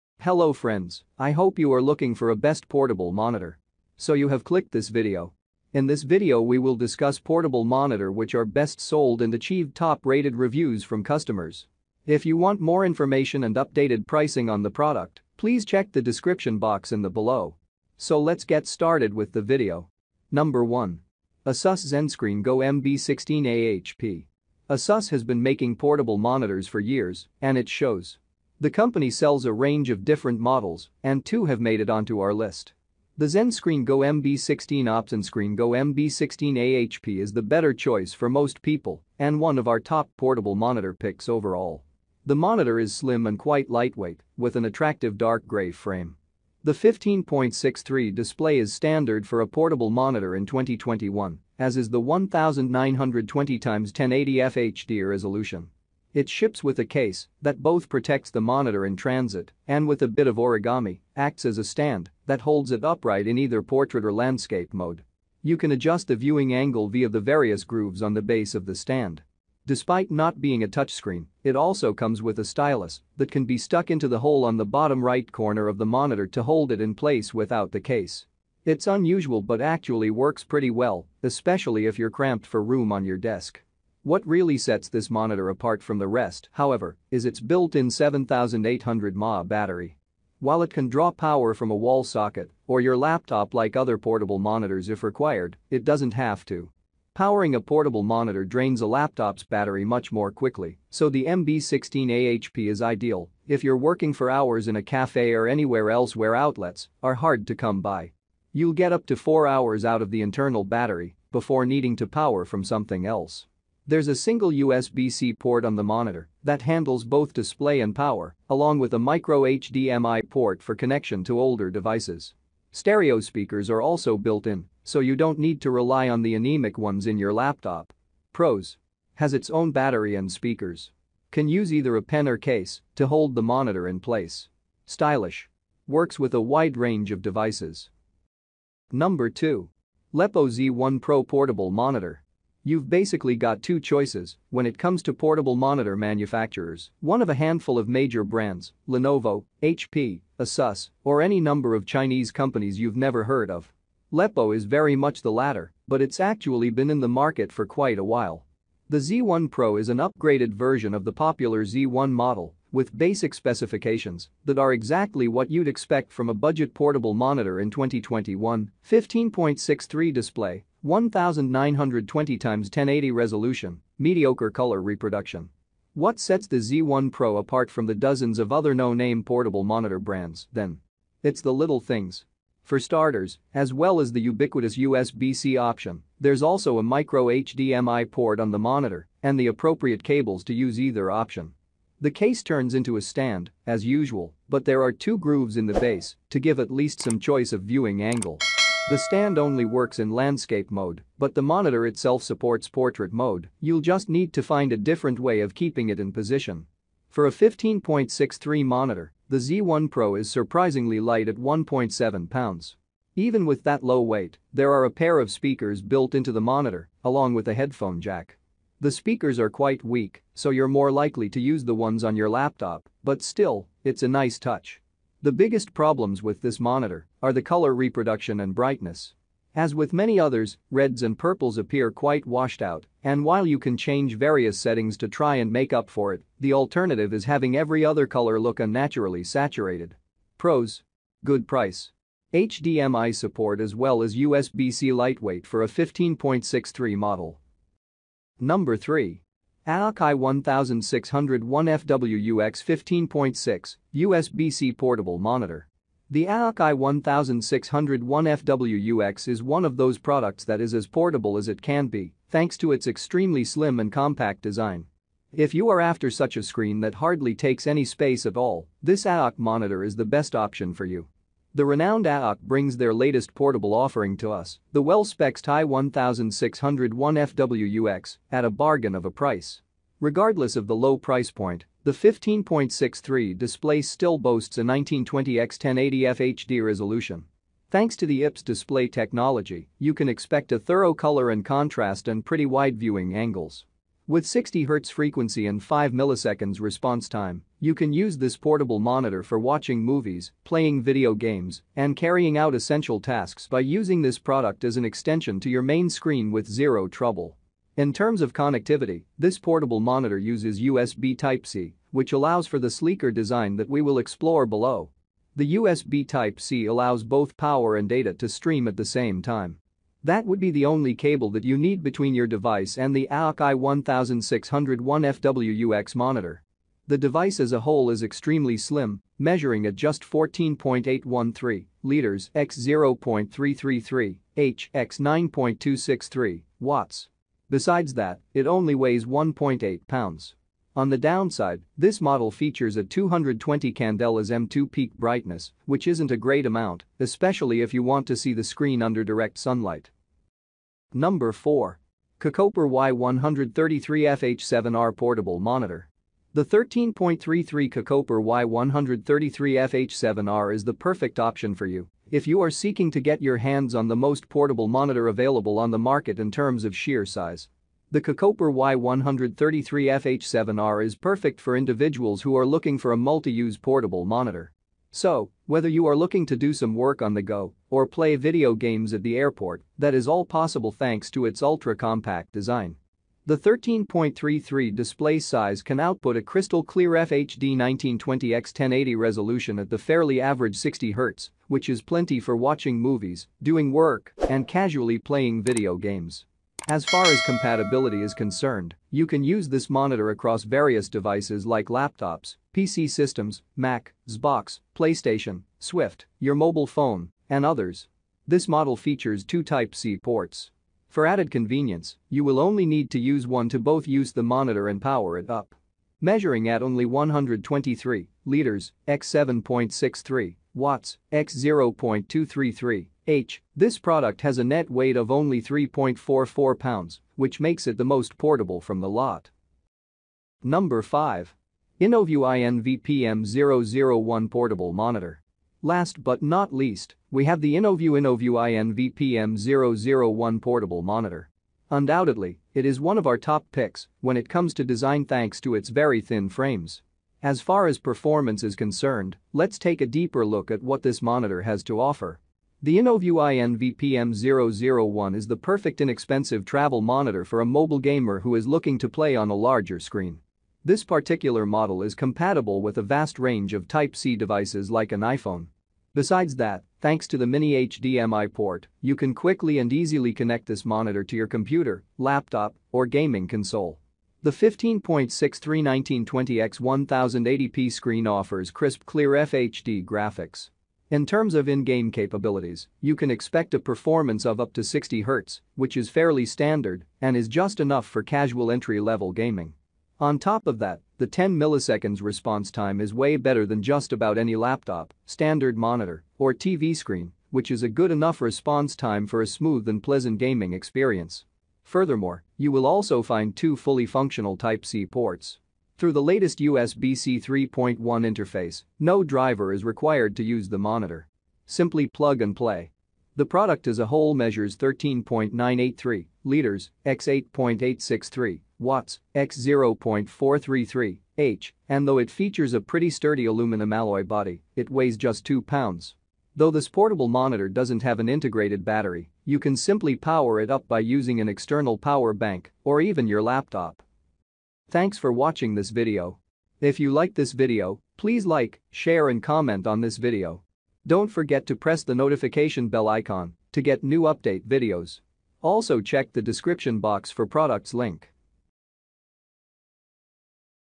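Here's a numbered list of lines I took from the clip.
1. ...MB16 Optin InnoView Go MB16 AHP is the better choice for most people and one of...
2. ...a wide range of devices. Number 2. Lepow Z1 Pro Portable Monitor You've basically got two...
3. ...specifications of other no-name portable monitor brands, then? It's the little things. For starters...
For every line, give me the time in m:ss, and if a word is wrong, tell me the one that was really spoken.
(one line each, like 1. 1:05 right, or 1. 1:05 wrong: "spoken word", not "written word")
1. 0:34 wrong: "Screen", not "InnoView"
2. 2:16 right
3. 2:57 wrong: "dozens", not "specifications".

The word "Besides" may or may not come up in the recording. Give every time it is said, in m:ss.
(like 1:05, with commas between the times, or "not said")
5:37, 7:45.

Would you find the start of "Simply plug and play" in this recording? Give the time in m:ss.
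8:31.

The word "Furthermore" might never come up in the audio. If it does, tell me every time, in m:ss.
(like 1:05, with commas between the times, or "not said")
8:21.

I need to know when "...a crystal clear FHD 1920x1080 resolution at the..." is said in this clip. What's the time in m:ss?
6:26.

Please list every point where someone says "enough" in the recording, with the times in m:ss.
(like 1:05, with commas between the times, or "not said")
8:07, 8:17.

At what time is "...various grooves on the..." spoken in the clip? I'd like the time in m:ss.
1:07.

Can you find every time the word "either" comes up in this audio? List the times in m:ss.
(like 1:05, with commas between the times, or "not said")
1:03, 2:11, 3:10.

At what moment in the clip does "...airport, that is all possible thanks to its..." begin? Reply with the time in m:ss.
6:19.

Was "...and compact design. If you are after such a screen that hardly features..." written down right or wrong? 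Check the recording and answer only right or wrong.
wrong.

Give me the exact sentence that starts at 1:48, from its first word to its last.
You'll get up to 4 hours out of the internal battery before needing to power from something else.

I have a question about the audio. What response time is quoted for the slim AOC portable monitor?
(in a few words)
5 milliseconds.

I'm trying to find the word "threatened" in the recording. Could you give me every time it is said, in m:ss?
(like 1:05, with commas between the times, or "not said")
not said.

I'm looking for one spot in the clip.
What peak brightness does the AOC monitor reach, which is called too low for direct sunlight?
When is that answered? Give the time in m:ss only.
5:42.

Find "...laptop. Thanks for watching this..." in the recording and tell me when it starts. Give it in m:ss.
8:53.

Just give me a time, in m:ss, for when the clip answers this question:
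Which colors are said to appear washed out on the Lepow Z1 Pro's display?
3:50.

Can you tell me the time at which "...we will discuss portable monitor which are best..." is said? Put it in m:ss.
0:06.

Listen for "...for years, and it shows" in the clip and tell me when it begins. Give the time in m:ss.
0:26.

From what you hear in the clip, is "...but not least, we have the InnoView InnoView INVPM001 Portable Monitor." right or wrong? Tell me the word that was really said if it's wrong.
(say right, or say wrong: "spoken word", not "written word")
right.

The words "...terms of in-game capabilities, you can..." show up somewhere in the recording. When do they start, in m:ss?
8:01.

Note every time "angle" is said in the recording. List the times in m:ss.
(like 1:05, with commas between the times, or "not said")
1:06, 3:18, 4:53.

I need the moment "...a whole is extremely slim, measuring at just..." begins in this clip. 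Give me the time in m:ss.
5:27.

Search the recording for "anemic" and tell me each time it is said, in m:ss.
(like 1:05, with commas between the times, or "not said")
2:06.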